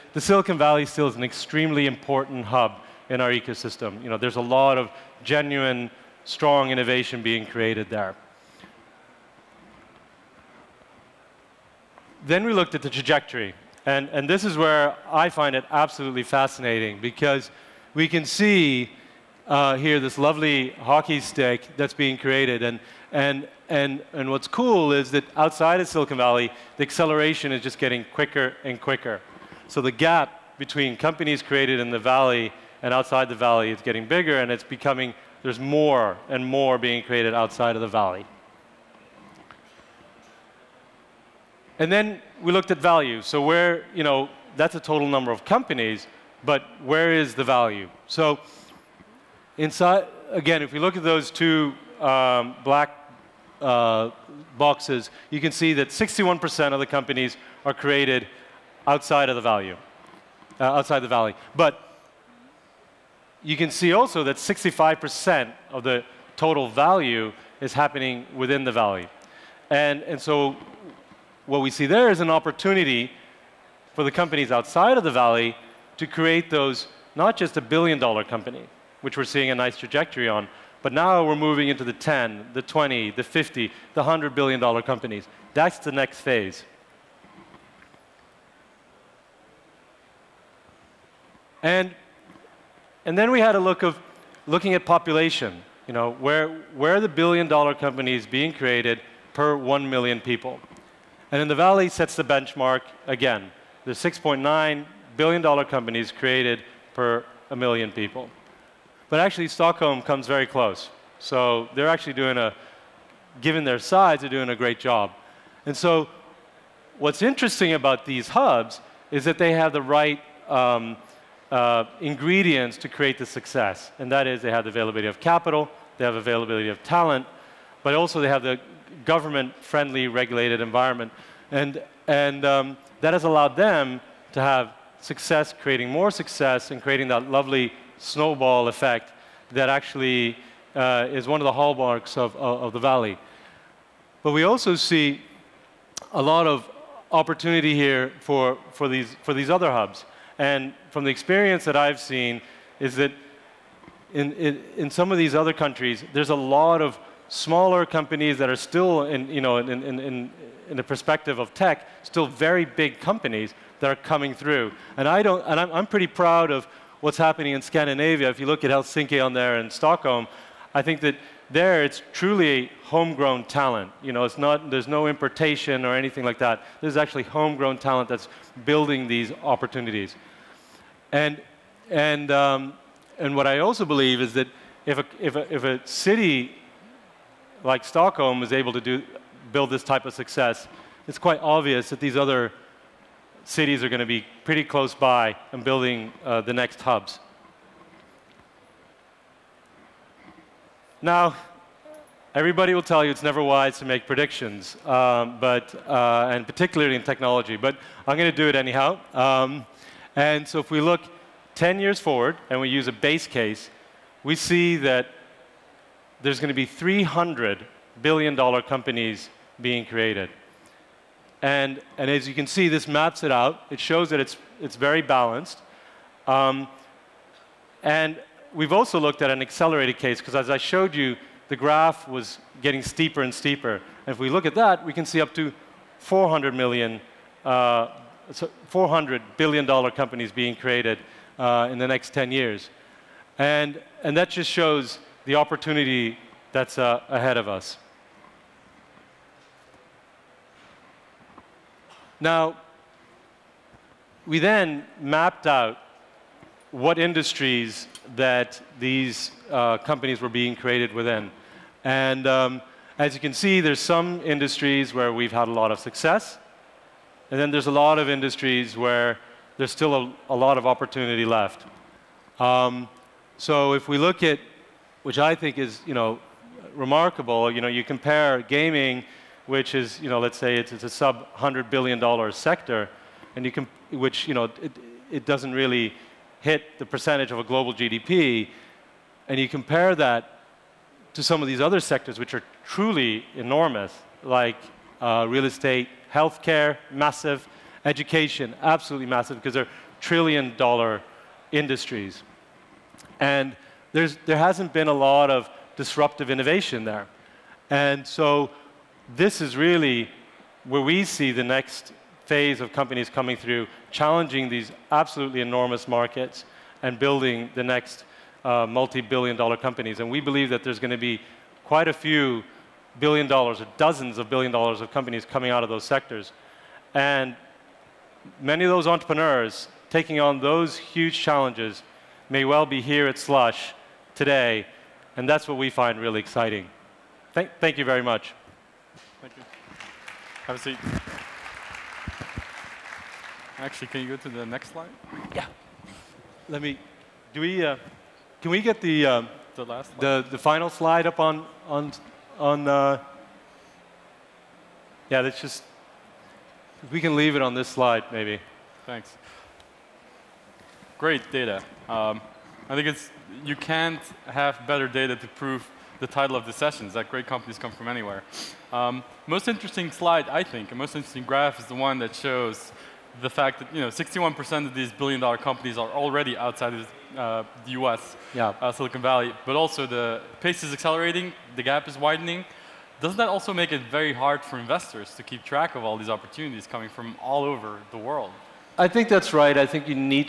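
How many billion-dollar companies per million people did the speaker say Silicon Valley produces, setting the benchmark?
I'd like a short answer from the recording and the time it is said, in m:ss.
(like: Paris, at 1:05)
6.9, at 1:43.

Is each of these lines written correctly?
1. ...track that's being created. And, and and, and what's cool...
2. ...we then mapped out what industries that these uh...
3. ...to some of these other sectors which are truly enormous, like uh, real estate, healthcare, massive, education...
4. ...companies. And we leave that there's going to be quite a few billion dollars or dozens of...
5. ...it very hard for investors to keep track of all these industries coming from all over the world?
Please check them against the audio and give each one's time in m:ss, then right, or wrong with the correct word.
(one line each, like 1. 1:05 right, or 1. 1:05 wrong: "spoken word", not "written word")
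1. 0:21 wrong: "stick", not "track"
2. 4:14 right
3. 4:51 right
4. 5:19 wrong: "believe", not "leave"
5. 6:23 wrong: "opportunities", not "industries".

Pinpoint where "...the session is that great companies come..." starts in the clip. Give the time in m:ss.
6:06.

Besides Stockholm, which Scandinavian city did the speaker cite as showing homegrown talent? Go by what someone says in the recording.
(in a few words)
Helsinki.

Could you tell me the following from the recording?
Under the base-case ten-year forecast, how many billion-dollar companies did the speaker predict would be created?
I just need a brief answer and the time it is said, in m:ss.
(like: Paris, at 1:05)
300, at 3:36.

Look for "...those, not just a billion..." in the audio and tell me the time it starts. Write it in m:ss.
1:16.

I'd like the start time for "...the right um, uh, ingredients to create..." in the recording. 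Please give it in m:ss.
1:59.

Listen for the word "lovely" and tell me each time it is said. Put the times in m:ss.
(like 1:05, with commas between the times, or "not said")
0:20, 2:17.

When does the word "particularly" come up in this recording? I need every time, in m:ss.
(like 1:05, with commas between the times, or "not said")
3:26.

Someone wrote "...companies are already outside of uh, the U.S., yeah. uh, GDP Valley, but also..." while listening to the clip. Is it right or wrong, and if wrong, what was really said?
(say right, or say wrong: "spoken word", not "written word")
wrong: "Silicon", not "GDP".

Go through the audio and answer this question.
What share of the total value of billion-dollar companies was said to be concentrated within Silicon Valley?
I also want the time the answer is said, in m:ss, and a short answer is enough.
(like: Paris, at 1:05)
65%, at 1:04.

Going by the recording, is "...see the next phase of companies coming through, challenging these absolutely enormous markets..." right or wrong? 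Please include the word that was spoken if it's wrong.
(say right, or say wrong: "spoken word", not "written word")
right.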